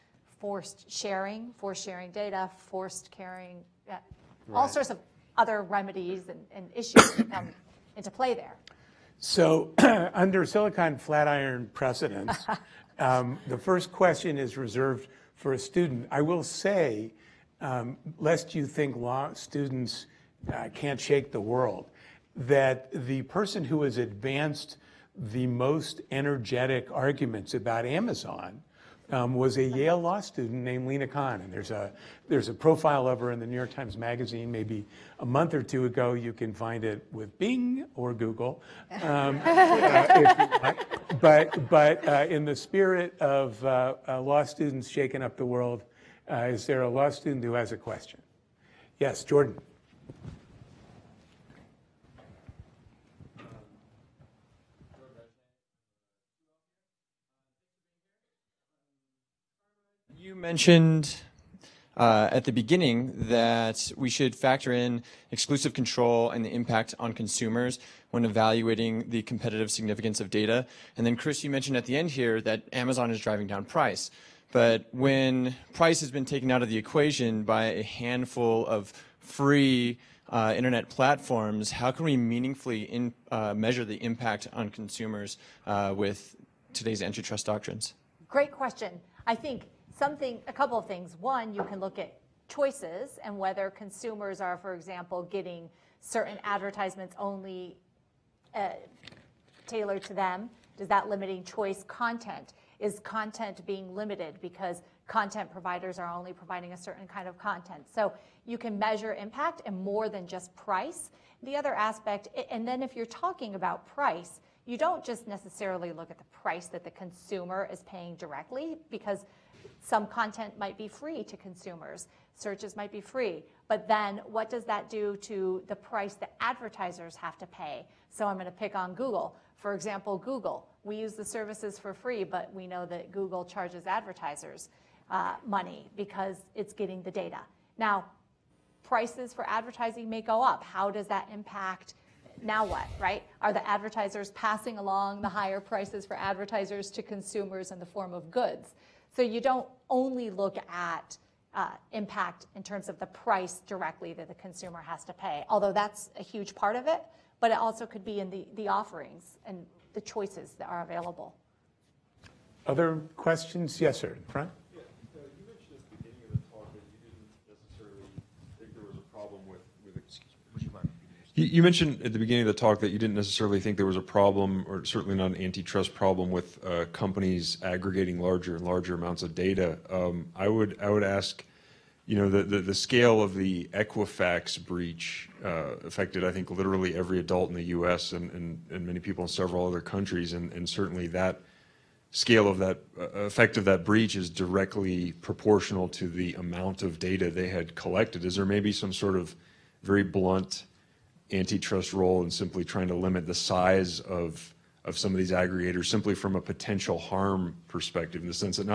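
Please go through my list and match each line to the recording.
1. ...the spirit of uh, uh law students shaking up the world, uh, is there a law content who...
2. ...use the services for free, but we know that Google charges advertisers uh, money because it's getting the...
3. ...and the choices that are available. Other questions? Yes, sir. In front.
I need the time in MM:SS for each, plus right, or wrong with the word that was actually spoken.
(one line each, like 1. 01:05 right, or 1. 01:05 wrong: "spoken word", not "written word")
1. 00:42 wrong: "student", not "content"
2. 02:10 right
3. 02:39 right.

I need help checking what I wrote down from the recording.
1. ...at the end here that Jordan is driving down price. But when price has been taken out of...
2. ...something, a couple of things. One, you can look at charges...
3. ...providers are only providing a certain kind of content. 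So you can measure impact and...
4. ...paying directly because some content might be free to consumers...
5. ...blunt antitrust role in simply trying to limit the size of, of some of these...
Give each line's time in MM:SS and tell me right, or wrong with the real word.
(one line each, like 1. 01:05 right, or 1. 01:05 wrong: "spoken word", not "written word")
1. 01:11 wrong: "Amazon", not "Jordan"
2. 01:29 wrong: "choices", not "charges"
3. 01:45 right
4. 01:57 right
5. 03:20 right.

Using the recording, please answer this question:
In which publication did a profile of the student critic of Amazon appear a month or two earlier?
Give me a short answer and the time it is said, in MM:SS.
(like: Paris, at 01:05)
New York Times Magazine, at 00:33.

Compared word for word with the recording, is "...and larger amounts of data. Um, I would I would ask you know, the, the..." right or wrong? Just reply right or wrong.
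right.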